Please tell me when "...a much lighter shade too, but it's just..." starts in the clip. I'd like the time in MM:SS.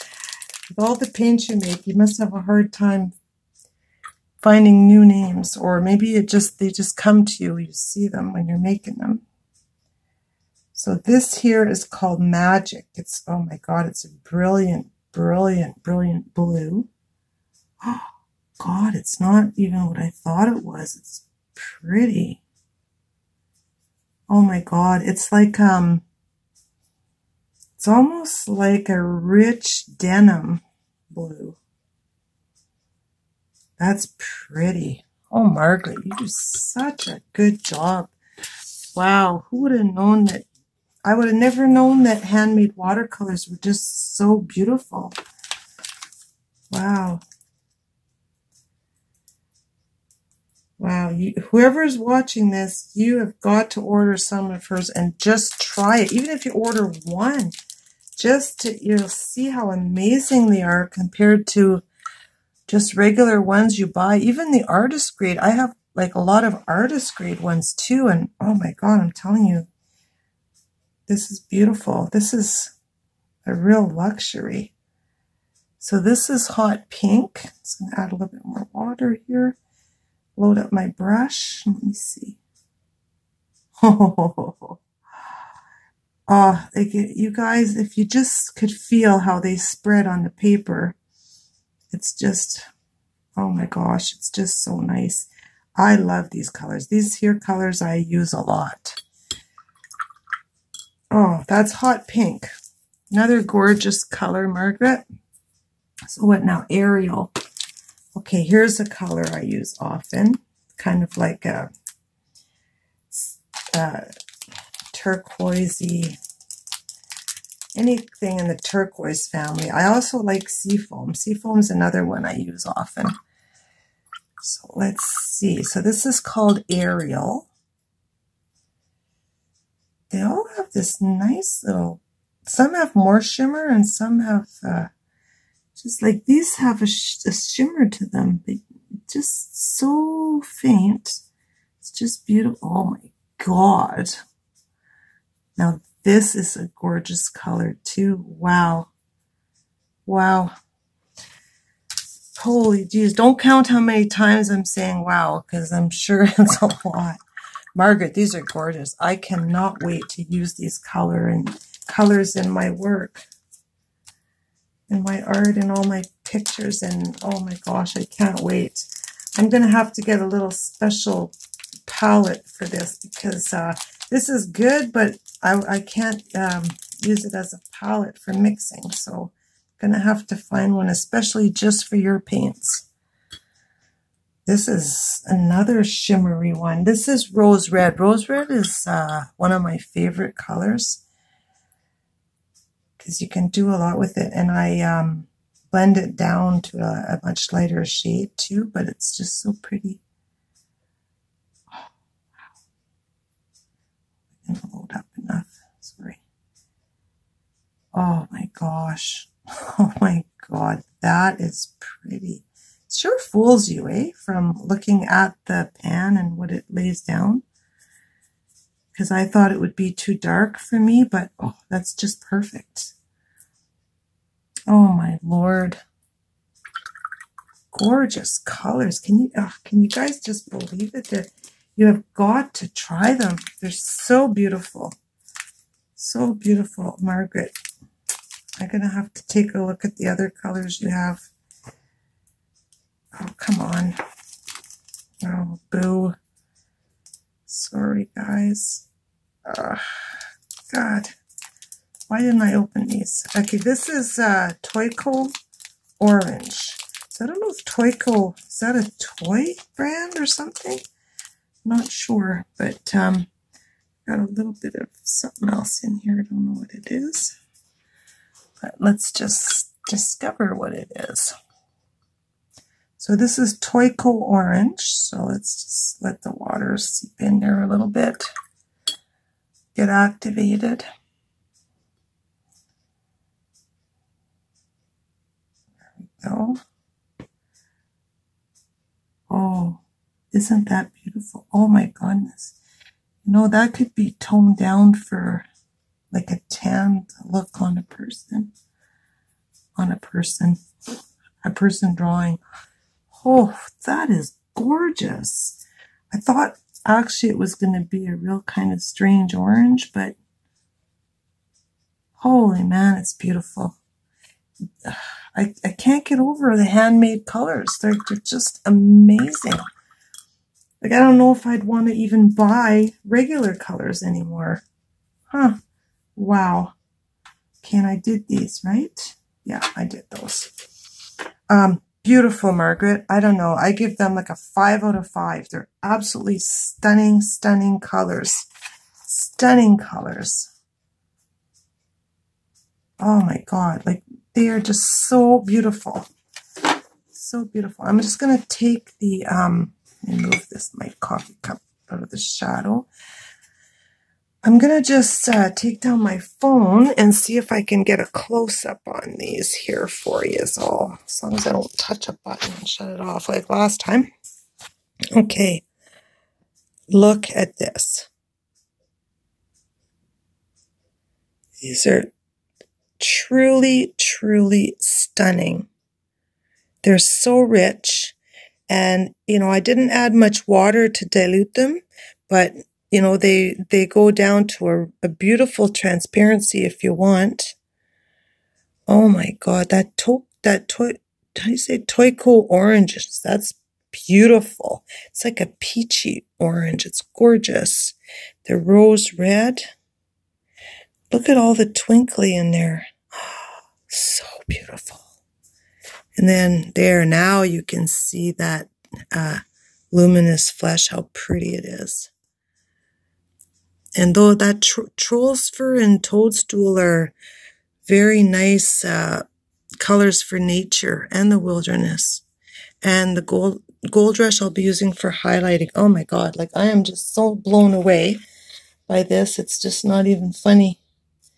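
03:17.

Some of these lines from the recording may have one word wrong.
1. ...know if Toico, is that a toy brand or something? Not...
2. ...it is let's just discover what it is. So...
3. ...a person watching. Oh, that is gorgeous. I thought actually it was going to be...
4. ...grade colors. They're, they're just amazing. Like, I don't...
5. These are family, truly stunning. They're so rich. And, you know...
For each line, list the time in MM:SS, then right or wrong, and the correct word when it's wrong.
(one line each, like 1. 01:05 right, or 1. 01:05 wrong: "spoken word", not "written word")
1. 04:17 wrong: "Toyco", not "Toico"
2. 04:26 right
3. 05:01 wrong: "drawing", not "watching"
4. 05:16 wrong: "handmade", not "grade"
5. 06:11 wrong: "truly", not "family".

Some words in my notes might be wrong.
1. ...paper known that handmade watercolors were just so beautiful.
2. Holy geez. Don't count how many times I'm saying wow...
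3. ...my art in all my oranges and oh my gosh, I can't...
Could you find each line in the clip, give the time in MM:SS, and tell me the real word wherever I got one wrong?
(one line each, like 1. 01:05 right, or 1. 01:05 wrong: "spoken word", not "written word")
1. 00:41 wrong: "never", not "paper"
2. 02:32 right
3. 02:45 wrong: "pictures", not "oranges".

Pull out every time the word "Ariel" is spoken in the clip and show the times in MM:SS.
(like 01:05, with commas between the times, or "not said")
01:46, 02:06.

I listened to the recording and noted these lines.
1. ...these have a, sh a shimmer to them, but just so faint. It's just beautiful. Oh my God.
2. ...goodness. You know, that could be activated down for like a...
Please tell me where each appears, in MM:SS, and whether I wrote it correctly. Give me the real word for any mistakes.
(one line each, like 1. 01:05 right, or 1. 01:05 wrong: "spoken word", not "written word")
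1. 02:16 right
2. 04:51 wrong: "toned", not "activated".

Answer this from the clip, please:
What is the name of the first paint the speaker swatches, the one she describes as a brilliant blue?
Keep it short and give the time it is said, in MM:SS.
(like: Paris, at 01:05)
Magic, at 00:12.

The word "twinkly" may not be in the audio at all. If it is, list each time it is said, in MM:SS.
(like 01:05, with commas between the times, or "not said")
06:41.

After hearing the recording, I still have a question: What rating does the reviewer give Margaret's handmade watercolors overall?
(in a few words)
5 out of 5.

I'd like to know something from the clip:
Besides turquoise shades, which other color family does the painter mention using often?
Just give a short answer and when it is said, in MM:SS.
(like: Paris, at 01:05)
Seafoam, at 02:00.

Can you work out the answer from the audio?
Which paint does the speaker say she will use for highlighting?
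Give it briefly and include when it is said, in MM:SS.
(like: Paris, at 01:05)
Gold rush, at 07:03.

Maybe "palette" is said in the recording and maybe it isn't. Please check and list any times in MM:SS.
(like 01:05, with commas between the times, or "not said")
02:51, 02:57.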